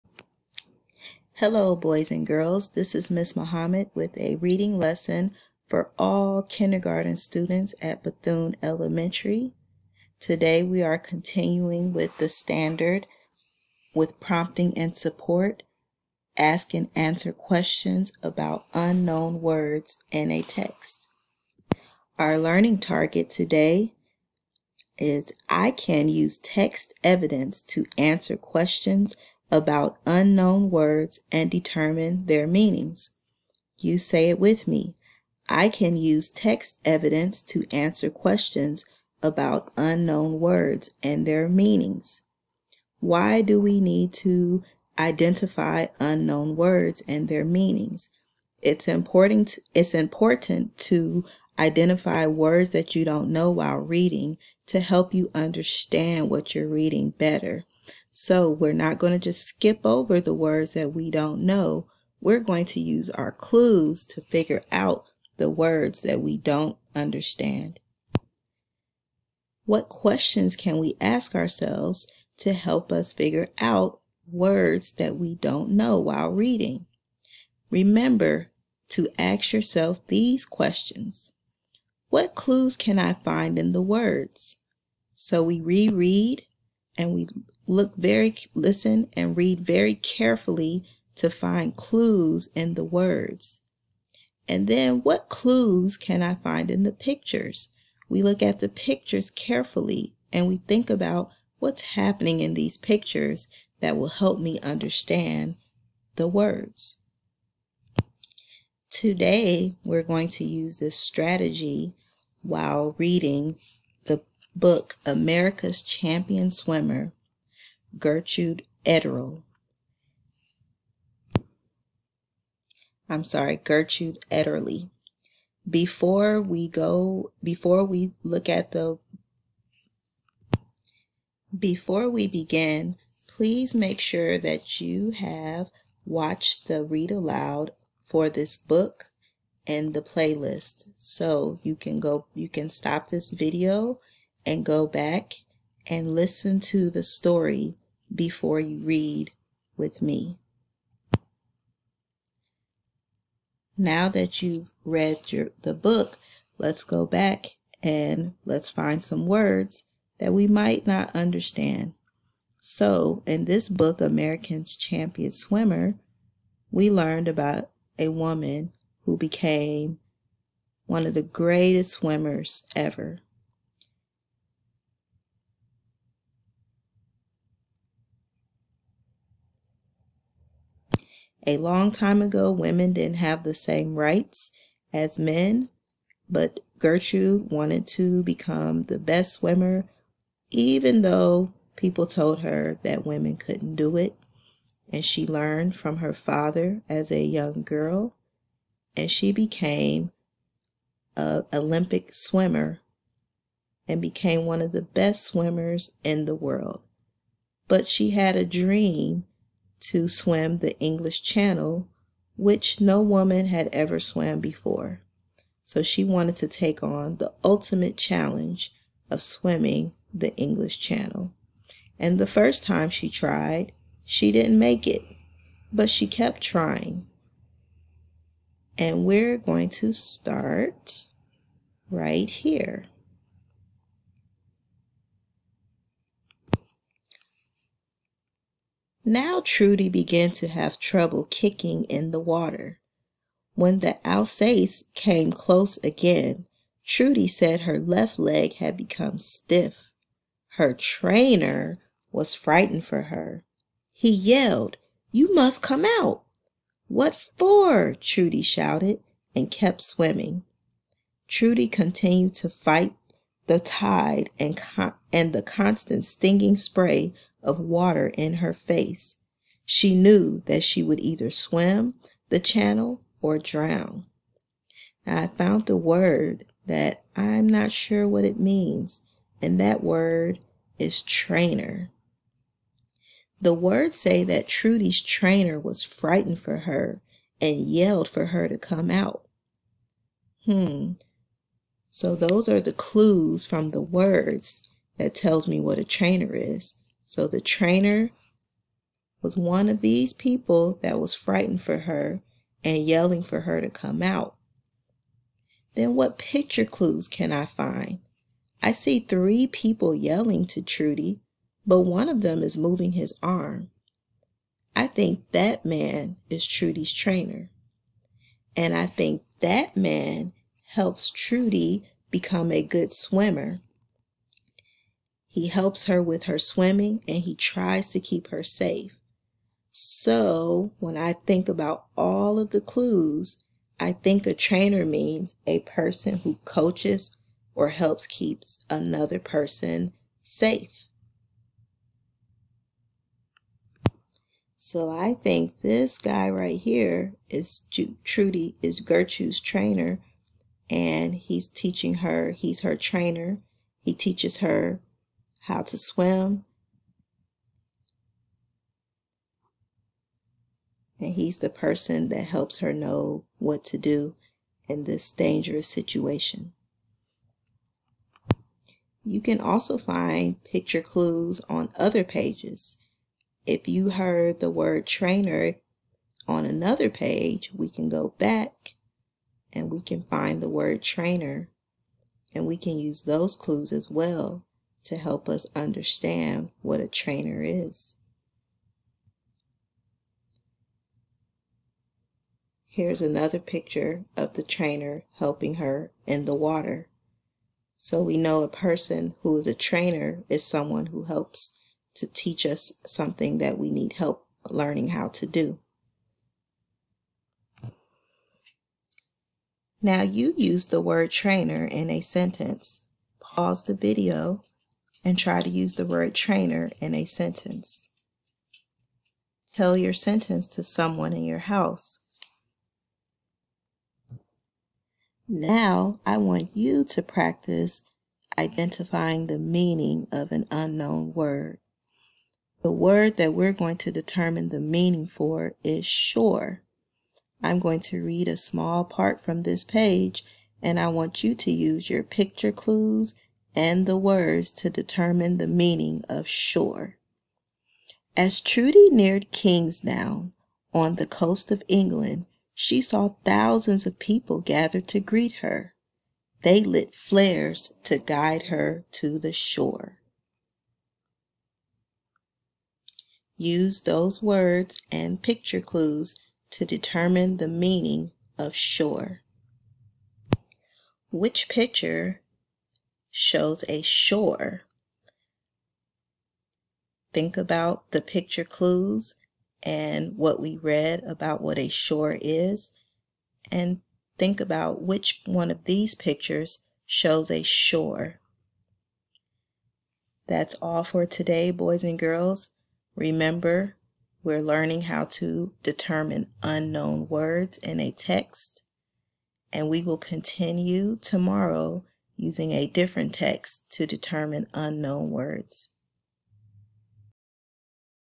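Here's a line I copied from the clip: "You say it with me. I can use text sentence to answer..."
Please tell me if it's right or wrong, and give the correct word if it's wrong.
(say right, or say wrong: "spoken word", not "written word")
wrong: "evidence", not "sentence".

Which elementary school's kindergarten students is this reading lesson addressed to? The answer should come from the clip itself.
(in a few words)
Bethune Elementary.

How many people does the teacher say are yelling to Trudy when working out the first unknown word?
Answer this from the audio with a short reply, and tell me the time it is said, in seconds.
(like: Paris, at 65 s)
3, at 309 s.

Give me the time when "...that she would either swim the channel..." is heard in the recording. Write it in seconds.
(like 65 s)
270 s.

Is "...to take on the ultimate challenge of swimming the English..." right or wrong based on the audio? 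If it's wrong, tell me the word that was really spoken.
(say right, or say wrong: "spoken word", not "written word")
right.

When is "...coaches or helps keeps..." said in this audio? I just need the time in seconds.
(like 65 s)
336 s.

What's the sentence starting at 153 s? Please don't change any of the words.
Now that you've read your, the book, let's go back and let's find some words that we might not understand.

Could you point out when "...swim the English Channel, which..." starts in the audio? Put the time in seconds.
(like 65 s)
210 s.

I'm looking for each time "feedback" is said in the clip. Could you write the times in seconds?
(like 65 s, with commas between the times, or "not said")
not said.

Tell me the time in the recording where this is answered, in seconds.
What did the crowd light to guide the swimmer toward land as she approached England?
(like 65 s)
456 s.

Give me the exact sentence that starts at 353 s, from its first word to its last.
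He teaches her how to swim.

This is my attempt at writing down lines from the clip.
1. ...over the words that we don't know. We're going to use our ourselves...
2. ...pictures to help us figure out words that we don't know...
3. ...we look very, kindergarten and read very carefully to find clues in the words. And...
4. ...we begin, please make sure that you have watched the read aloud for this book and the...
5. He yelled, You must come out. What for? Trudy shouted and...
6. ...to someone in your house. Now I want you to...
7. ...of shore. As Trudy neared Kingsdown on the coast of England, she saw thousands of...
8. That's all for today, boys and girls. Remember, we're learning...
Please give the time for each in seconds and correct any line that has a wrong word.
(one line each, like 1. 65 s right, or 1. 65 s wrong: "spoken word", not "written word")
1. 59 s wrong: "clues", not "ourselves"
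2. 71 s wrong: "ourselves", not "pictures"
3. 87 s wrong: "listen", not "kindergarten"
4. 132 s right
5. 253 s right
6. 420 s right
7. 446 s right
8. 490 s right.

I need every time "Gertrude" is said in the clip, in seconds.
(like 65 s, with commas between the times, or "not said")
117 s, 123 s, 186 s, 348 s.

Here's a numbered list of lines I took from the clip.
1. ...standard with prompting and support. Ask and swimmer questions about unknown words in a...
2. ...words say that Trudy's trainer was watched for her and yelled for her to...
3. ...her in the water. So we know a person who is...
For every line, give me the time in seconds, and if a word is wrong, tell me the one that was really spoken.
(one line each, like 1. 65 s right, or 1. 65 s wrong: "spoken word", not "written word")
1. 12 s wrong: "answer", not "swimmer"
2. 283 s wrong: "frightened", not "watched"
3. 395 s right.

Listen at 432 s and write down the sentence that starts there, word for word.
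The word that we're going to determine the meaning for is sure.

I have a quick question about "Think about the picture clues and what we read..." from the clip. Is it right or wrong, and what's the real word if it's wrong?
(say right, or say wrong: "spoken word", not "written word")
right.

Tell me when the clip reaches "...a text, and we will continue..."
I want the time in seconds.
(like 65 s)
497 s.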